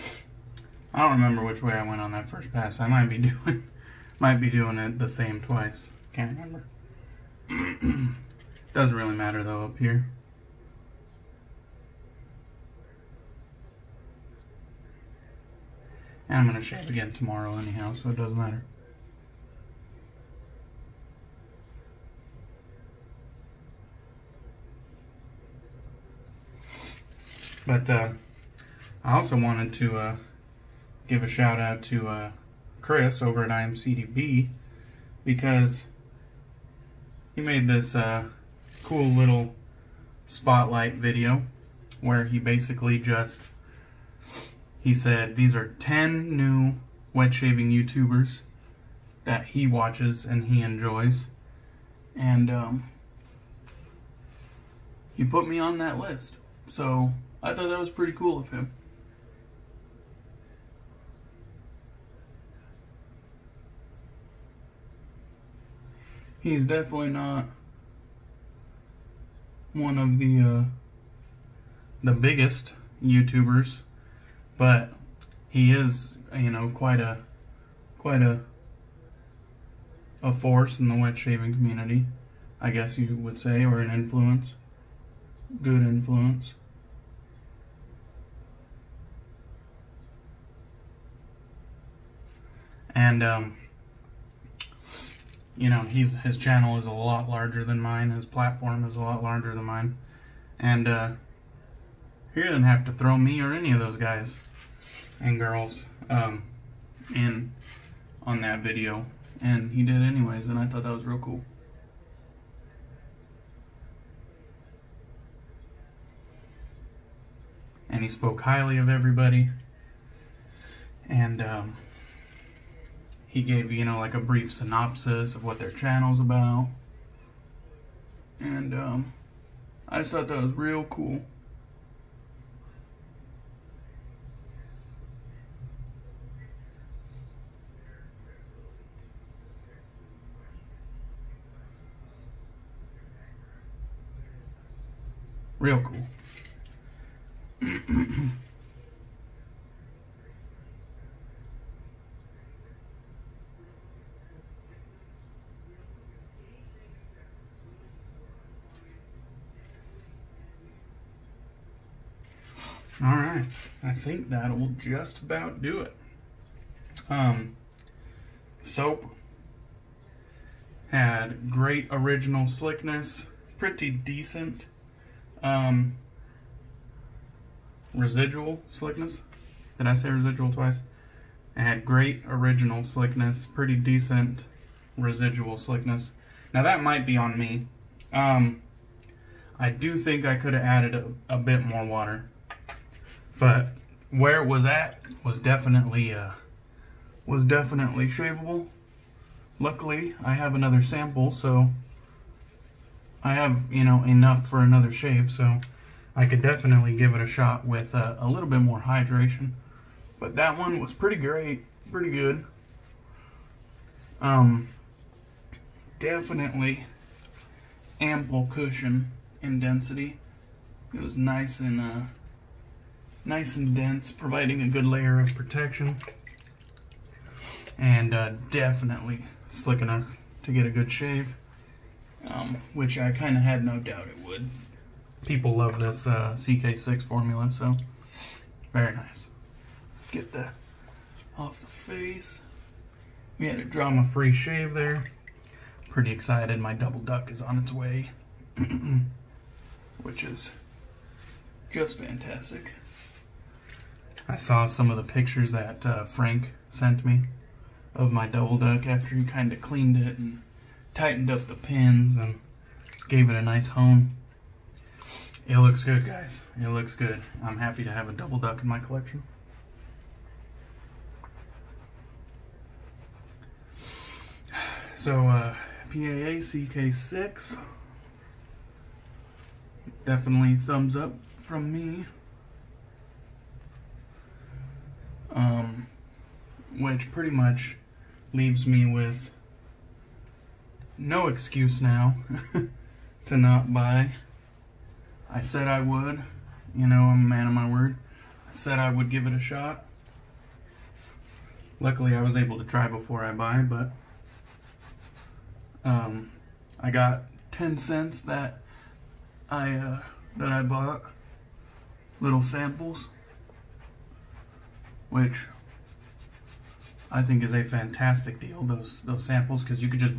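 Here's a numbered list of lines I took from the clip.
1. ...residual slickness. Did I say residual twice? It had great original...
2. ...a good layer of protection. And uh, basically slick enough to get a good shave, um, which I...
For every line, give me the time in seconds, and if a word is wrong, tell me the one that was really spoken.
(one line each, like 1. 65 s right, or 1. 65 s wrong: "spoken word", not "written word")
1. 177 s right
2. 224 s wrong: "definitely", not "basically".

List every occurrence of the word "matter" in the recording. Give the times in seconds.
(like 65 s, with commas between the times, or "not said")
9 s, 18 s.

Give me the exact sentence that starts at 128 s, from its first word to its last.
And um, I just thought that was real cool.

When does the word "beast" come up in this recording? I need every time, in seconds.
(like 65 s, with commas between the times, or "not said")
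not said.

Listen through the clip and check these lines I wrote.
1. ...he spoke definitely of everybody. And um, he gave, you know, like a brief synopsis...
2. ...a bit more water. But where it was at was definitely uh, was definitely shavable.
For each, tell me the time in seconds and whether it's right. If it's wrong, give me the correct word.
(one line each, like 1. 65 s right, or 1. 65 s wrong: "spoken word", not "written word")
1. 118 s wrong: "highly", not "definitely"
2. 191 s right.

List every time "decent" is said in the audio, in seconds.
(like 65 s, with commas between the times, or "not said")
173 s, 183 s.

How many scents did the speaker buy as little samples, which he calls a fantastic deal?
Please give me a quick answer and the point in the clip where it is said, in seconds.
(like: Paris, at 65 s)
10, at 307 s.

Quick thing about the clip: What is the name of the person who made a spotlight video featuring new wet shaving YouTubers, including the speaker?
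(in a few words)
Chris.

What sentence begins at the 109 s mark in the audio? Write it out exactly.
And he did anyways, and I thought that was real cool.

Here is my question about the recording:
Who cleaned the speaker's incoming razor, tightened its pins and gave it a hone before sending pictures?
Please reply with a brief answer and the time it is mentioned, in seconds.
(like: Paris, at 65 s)
Frank, at 256 s.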